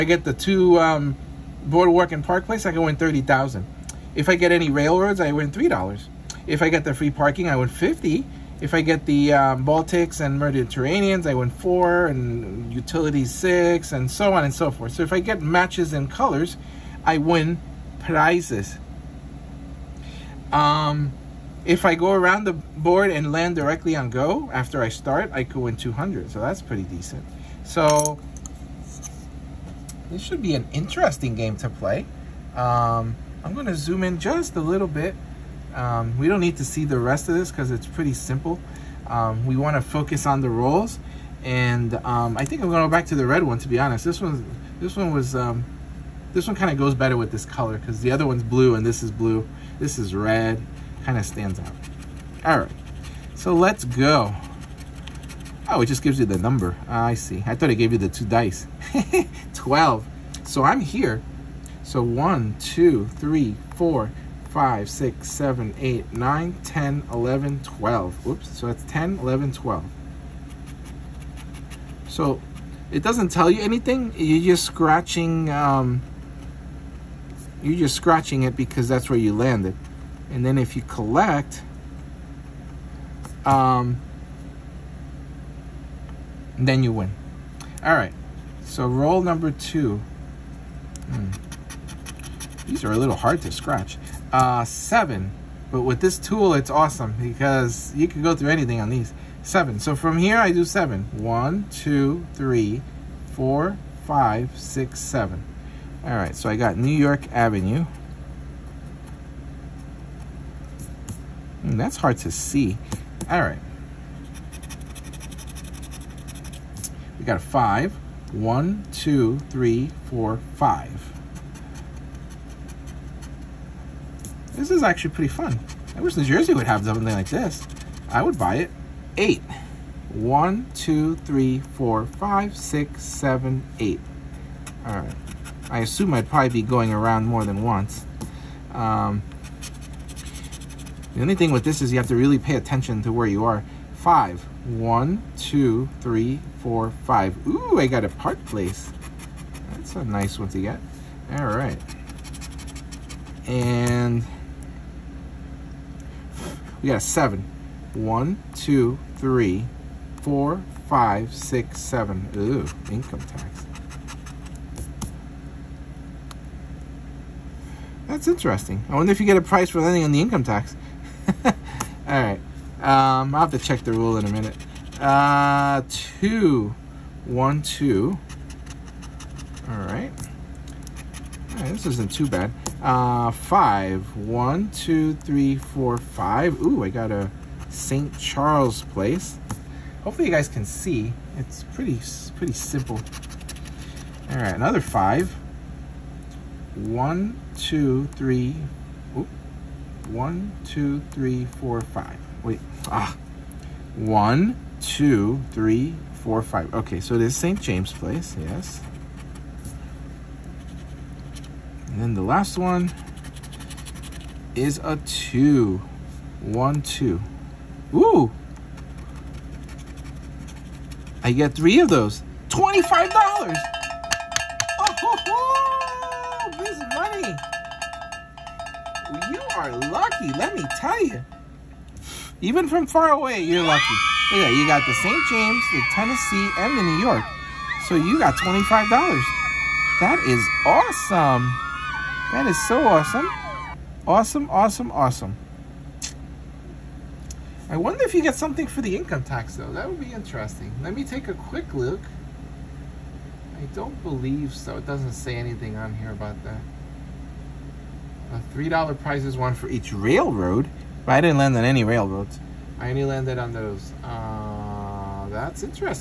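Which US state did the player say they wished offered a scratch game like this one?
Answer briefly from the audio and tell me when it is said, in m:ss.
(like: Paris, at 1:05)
New Jersey, at 2:06.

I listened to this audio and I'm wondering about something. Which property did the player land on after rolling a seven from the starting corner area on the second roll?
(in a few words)
New York Avenue.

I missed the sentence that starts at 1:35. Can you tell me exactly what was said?
But with this tool, it's awesome because you can go through anything on these.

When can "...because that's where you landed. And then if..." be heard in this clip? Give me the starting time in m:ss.
1:18.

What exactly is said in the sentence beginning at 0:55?
Oh, it just gives you the number.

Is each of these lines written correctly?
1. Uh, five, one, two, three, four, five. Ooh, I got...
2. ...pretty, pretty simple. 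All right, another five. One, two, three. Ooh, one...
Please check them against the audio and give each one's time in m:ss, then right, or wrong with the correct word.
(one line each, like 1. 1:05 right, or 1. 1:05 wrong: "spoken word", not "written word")
1. 3:02 right
2. 3:11 right.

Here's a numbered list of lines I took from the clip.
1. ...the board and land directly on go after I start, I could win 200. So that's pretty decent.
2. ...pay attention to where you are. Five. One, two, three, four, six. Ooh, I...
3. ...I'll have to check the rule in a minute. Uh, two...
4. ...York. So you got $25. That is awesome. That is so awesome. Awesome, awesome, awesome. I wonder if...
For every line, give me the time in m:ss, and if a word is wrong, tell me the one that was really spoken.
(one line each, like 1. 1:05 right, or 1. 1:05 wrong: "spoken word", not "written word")
1. 0:22 right
2. 2:22 wrong: "five", not "six"
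3. 2:53 right
4. 3:56 right.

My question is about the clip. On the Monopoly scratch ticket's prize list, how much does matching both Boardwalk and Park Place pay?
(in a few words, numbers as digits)
30000.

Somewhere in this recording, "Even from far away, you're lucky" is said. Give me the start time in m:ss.
3:52.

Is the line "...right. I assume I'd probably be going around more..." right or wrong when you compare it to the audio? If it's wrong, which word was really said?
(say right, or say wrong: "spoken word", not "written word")
right.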